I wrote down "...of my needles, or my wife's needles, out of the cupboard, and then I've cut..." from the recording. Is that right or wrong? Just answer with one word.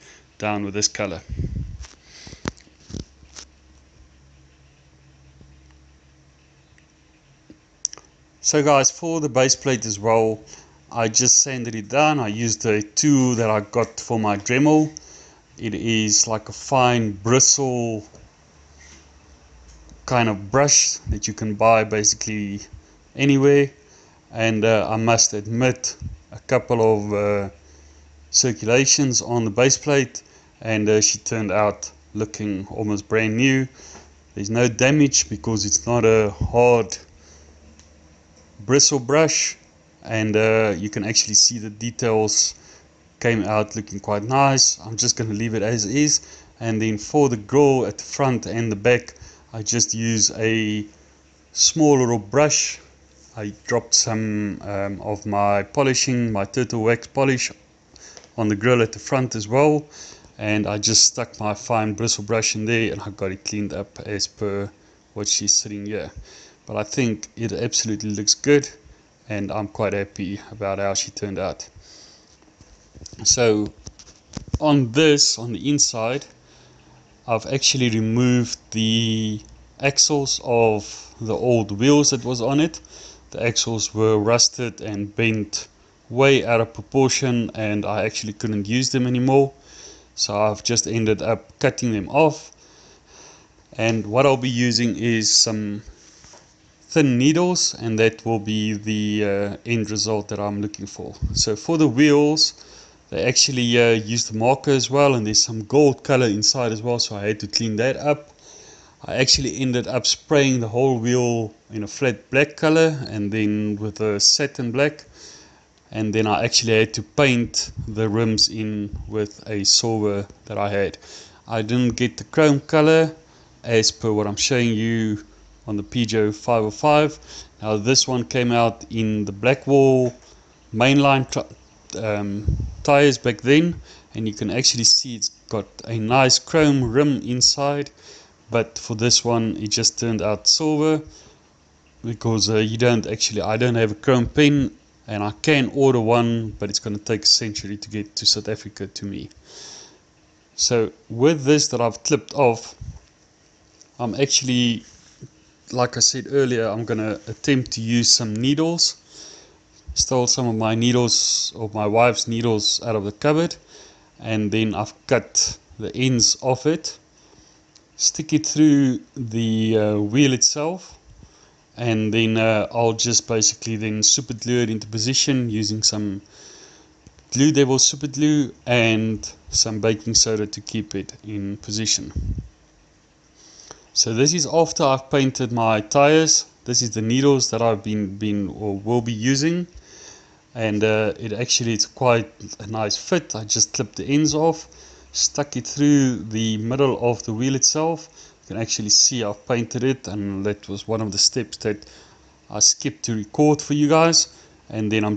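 right.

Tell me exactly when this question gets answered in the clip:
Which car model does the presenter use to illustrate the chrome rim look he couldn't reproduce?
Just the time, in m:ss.
2:05.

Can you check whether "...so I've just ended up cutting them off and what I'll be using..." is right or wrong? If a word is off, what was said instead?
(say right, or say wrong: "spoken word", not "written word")
right.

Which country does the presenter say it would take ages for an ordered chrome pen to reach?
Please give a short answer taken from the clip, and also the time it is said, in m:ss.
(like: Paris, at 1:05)
South Africa, at 2:28.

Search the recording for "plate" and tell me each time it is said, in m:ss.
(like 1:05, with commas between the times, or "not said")
0:09, 0:29.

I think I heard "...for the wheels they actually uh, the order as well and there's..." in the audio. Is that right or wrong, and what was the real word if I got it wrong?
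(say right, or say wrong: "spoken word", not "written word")
wrong: "marker", not "order".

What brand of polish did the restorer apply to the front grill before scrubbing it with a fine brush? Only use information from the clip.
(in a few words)
Turtle Wax.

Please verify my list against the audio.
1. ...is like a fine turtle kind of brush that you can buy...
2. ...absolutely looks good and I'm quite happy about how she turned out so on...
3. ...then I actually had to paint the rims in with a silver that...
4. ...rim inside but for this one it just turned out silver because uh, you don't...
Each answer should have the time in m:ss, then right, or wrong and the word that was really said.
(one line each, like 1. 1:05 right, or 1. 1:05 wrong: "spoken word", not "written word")
1. 0:15 wrong: "bristle", not "turtle"
2. 1:07 right
3. 1:56 right
4. 2:16 right.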